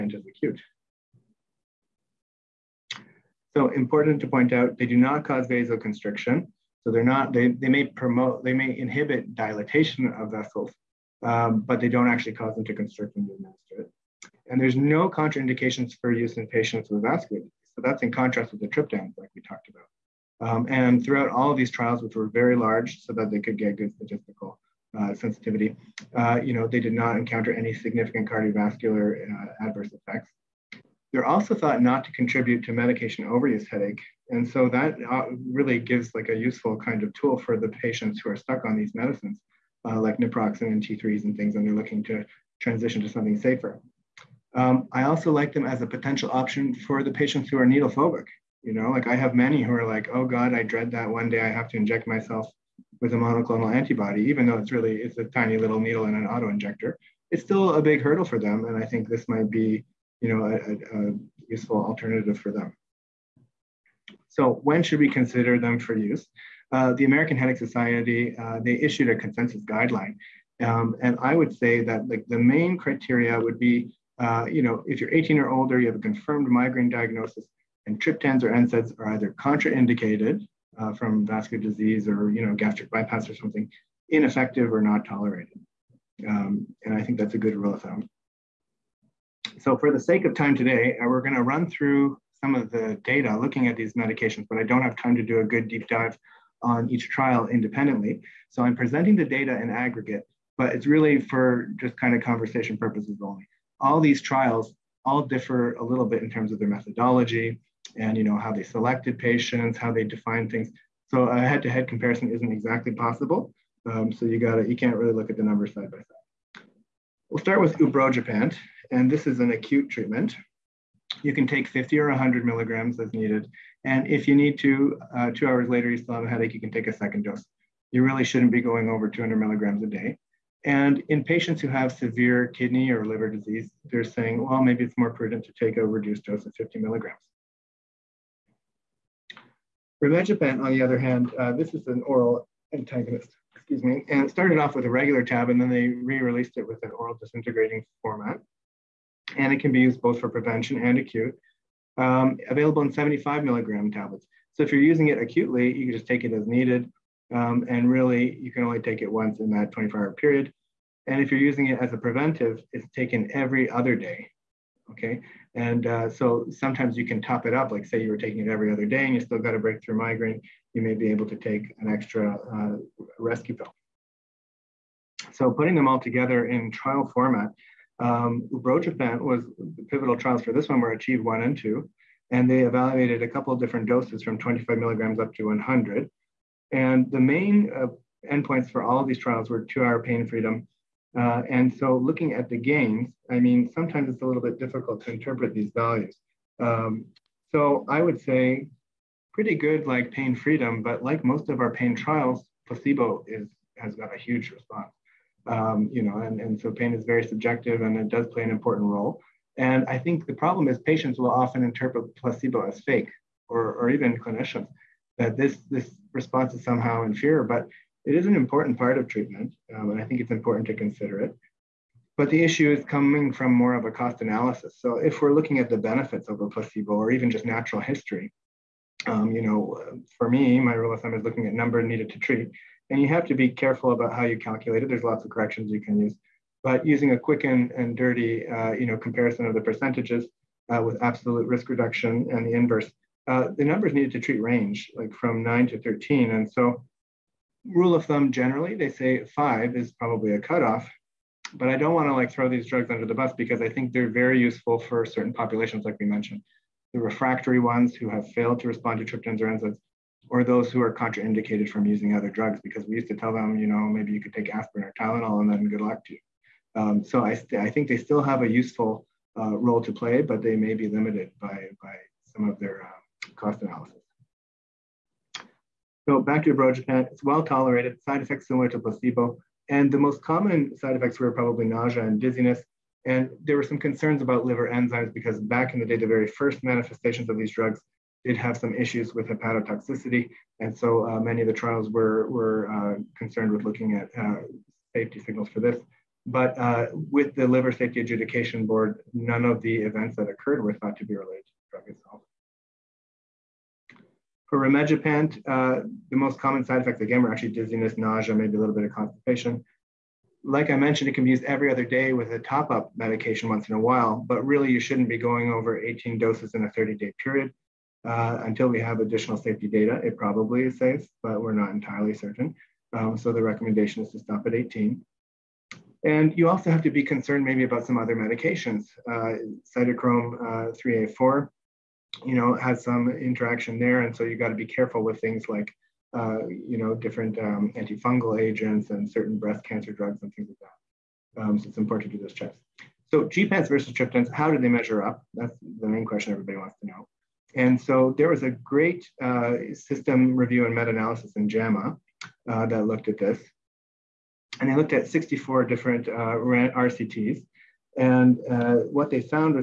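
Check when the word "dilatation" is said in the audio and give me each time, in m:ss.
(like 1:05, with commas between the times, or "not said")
0:09.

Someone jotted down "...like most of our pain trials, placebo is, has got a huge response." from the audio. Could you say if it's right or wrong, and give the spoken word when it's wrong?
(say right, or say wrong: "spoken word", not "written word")
right.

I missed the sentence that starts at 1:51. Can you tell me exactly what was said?
So a head-to-head comparison isn't exactly possible.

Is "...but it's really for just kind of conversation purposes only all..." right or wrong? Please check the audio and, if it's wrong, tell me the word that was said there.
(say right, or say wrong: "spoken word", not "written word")
right.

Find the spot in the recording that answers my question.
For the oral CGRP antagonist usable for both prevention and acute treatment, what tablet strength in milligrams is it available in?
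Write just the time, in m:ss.
2:32.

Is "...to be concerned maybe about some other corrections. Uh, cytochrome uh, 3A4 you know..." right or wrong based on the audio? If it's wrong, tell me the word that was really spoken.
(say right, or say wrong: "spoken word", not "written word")
wrong: "medications", not "corrections".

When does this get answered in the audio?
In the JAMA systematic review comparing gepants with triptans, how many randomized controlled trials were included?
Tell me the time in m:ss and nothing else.
5:55.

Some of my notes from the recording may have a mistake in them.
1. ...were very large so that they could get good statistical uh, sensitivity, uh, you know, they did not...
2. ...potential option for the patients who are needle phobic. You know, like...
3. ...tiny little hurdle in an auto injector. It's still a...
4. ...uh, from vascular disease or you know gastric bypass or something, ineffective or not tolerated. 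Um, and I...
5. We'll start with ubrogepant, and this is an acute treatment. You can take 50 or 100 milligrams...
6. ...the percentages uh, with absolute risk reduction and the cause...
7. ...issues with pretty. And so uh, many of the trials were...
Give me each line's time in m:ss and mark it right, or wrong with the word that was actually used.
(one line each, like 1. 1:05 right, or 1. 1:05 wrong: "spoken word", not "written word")
1. 0:22 right
2. 0:45 right
3. 0:55 wrong: "needle", not "hurdle"
4. 1:20 right
5. 1:57 right
6. 3:59 wrong: "inverse", not "cause"
7. 4:48 wrong: "hepatotoxicity", not "pretty".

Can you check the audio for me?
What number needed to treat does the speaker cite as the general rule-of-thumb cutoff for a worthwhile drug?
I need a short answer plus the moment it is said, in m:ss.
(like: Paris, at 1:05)
5, at 4:09.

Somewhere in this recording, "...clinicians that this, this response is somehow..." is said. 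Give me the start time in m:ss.
3:34.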